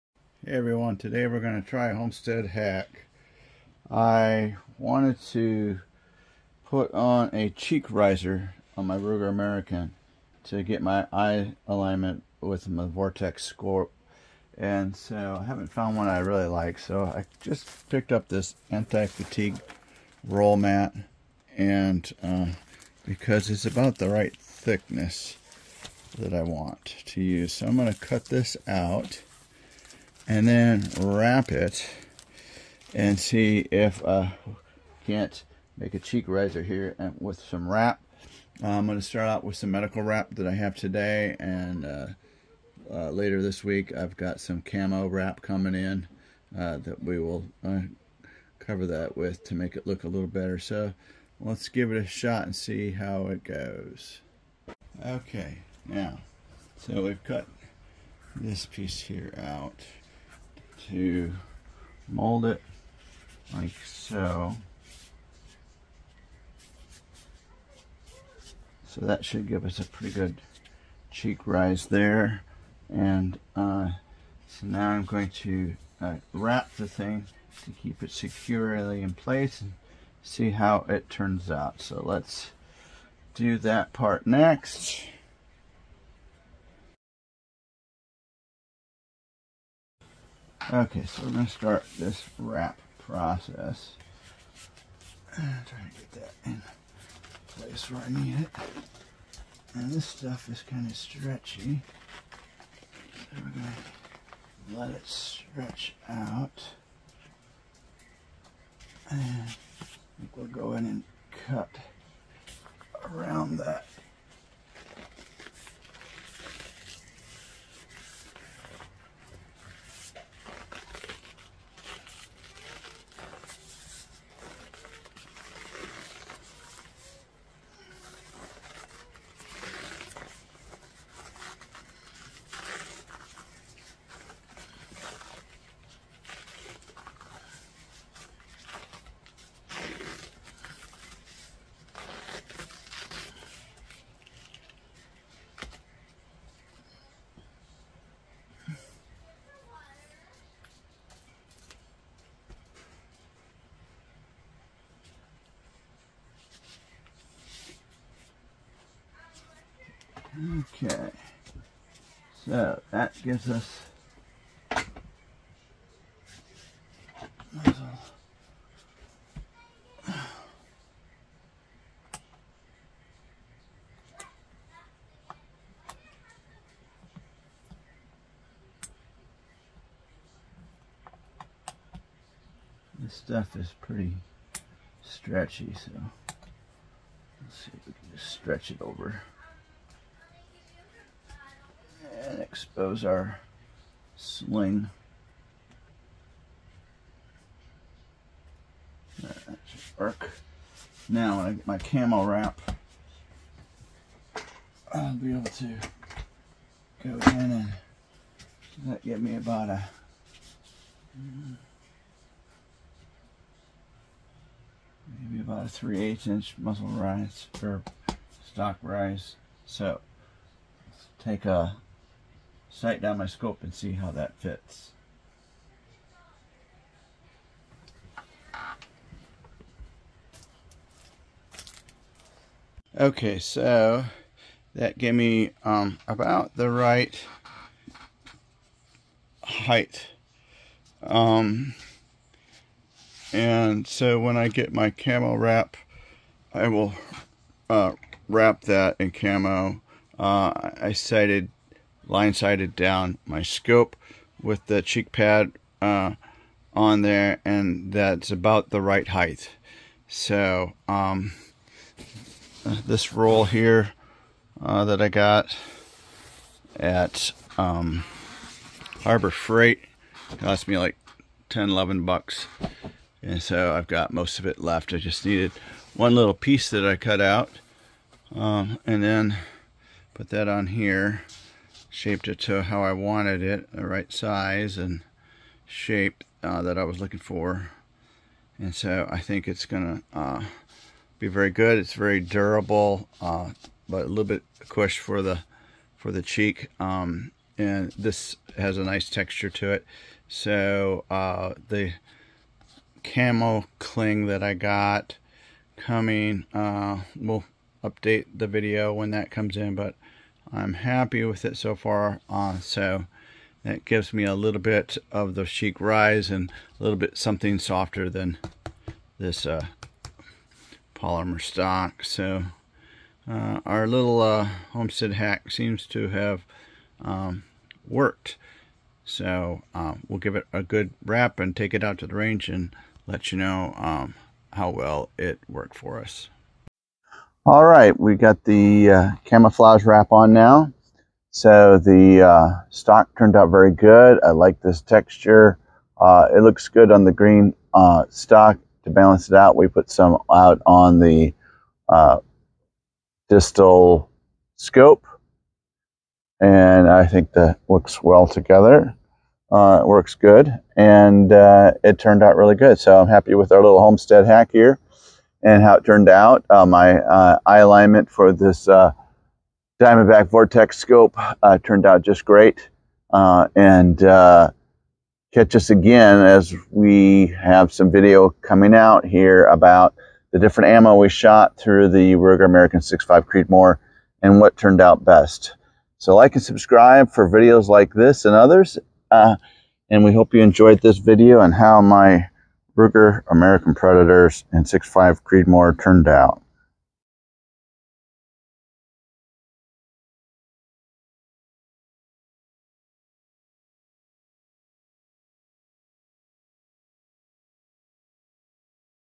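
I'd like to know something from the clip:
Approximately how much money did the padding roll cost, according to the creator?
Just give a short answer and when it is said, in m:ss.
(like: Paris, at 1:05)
10 to 11 dollars, at 4:31.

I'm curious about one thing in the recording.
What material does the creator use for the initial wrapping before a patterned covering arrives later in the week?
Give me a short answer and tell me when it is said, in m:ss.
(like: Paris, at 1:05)
Medical wrap, at 0:39.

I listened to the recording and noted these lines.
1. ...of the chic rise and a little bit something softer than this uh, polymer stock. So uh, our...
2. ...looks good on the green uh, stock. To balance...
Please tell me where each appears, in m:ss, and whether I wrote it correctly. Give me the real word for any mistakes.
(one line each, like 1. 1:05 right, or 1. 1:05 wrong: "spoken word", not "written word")
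1. 5:15 right
2. 5:46 right.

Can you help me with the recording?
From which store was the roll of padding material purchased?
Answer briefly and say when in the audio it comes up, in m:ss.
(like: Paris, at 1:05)
Harbor Freight, at 4:29.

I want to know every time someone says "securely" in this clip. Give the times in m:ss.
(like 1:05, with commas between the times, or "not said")
1:18.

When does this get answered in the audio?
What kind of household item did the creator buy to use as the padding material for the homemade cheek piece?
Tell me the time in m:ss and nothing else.
0:18.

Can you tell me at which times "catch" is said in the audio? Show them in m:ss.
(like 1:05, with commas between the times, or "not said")
6:15.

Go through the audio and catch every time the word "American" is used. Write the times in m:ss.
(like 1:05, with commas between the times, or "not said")
0:09, 6:22, 6:33.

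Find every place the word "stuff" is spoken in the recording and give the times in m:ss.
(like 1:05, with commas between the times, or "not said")
1:40, 3:03.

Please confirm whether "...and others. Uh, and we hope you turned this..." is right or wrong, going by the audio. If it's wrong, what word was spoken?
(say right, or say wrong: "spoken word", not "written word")
wrong: "enjoyed", not "turned".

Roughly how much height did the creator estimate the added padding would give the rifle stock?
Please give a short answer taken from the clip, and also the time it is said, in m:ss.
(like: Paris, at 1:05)
3/8 inch, at 3:35.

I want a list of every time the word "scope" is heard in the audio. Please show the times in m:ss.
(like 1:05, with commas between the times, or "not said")
0:13, 3:43, 4:13, 5:54, 6:10.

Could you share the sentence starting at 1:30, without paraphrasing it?
Okay, so we're going to start this wrap process.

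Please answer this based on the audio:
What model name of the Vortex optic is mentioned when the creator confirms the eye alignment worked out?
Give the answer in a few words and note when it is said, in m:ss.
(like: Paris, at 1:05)
Diamondback, at 6:09.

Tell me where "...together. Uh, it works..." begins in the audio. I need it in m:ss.
5:58.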